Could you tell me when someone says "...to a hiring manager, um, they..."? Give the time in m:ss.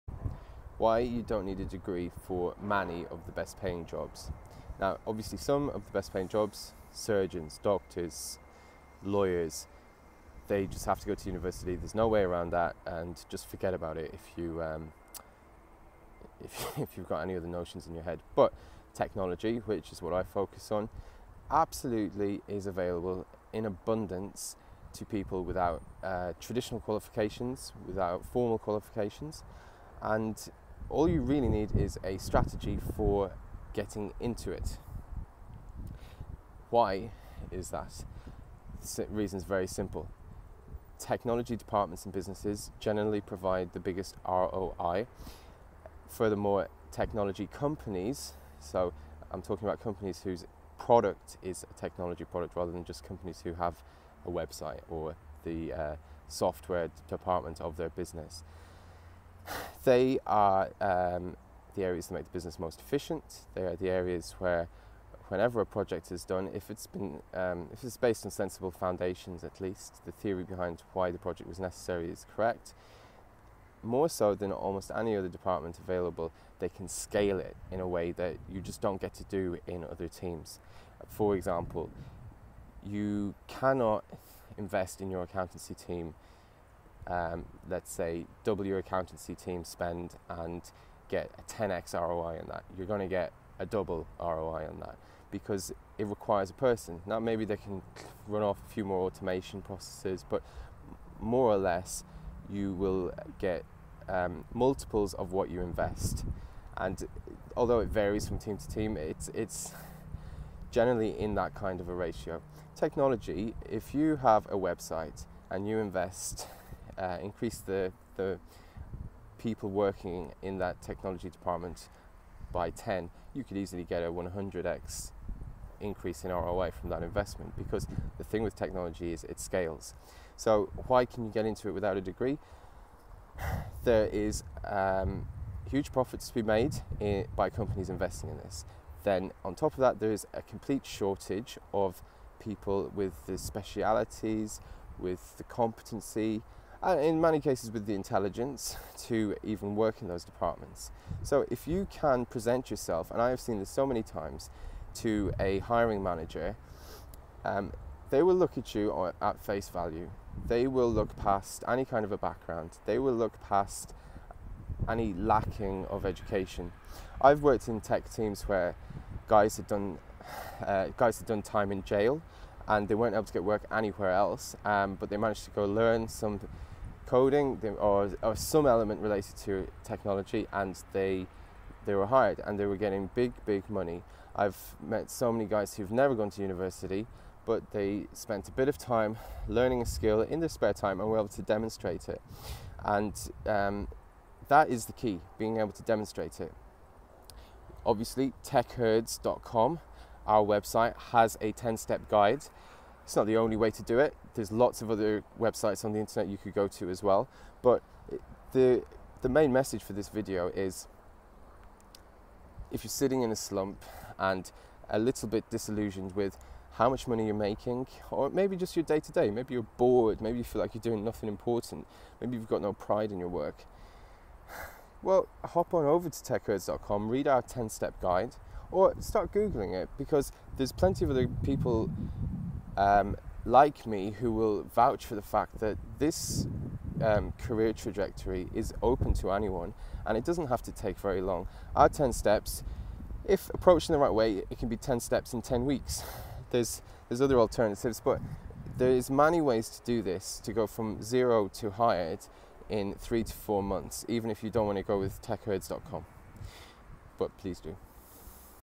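2:34.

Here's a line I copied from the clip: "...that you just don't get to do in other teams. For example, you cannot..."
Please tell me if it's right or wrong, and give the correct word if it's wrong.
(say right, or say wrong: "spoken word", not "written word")
right.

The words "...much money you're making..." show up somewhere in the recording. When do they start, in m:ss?
3:36.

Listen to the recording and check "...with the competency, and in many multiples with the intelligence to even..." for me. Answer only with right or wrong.
wrong.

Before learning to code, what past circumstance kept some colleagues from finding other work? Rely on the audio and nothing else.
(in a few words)
done time in jail.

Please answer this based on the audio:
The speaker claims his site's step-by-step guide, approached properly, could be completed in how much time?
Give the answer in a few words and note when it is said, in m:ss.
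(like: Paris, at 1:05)
10 weeks, at 4:05.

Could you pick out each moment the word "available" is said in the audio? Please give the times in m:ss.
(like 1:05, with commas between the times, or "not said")
0:22, 1:15.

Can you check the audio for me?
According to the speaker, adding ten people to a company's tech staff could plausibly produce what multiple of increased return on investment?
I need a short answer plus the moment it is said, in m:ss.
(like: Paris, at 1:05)
100x, at 2:04.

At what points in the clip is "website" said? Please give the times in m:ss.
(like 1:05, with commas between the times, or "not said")
0:54, 1:54, 3:20, 3:25.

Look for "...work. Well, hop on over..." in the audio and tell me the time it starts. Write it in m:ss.
3:43.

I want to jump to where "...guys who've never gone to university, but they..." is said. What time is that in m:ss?
3:05.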